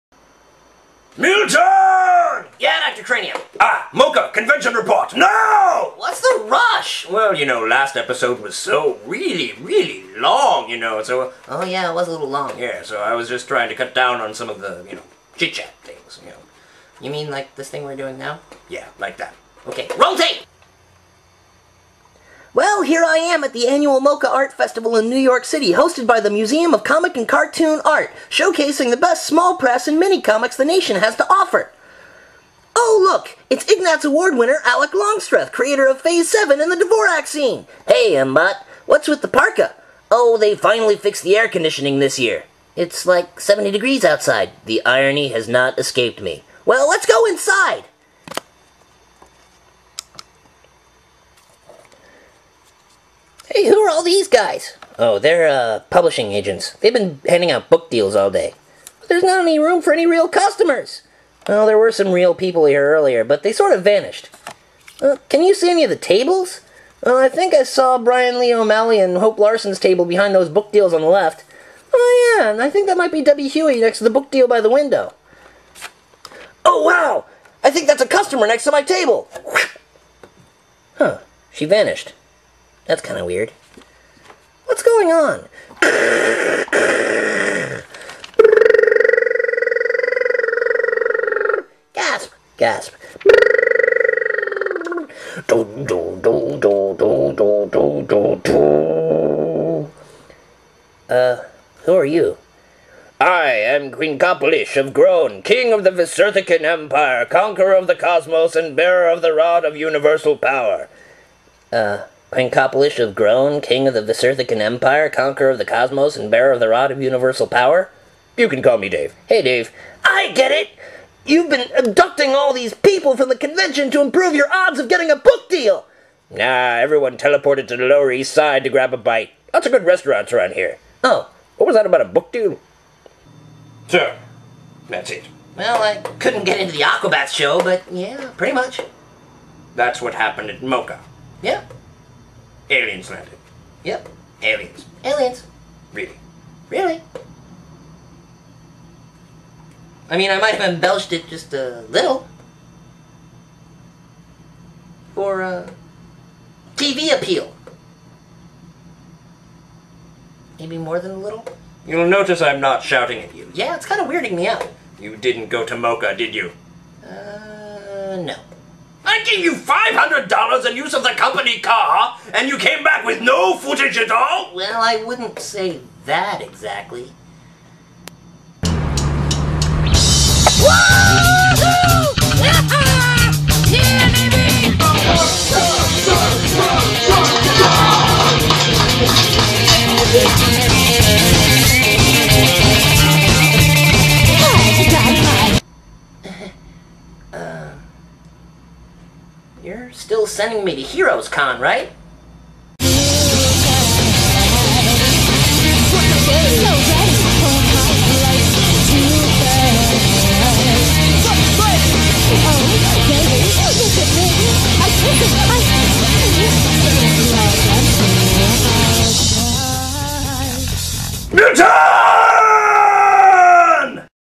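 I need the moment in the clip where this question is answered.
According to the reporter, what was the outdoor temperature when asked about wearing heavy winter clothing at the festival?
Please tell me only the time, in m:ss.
0:43.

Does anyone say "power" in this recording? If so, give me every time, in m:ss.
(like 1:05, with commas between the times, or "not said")
1:50, 1:57.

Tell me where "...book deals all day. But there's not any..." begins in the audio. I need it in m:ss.
0:57.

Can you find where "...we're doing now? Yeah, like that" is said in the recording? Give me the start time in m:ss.
0:17.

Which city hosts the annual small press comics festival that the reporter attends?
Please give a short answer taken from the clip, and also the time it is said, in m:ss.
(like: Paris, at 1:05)
New York City, at 0:25.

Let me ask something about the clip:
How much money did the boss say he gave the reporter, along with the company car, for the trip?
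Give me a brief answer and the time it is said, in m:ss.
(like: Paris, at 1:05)
$500, at 2:49.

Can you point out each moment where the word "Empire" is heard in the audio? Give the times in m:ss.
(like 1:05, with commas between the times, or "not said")
1:46, 1:54.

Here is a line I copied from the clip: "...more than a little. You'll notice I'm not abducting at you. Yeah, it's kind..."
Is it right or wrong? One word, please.
wrong.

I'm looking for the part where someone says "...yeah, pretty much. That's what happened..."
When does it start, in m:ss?
2:17.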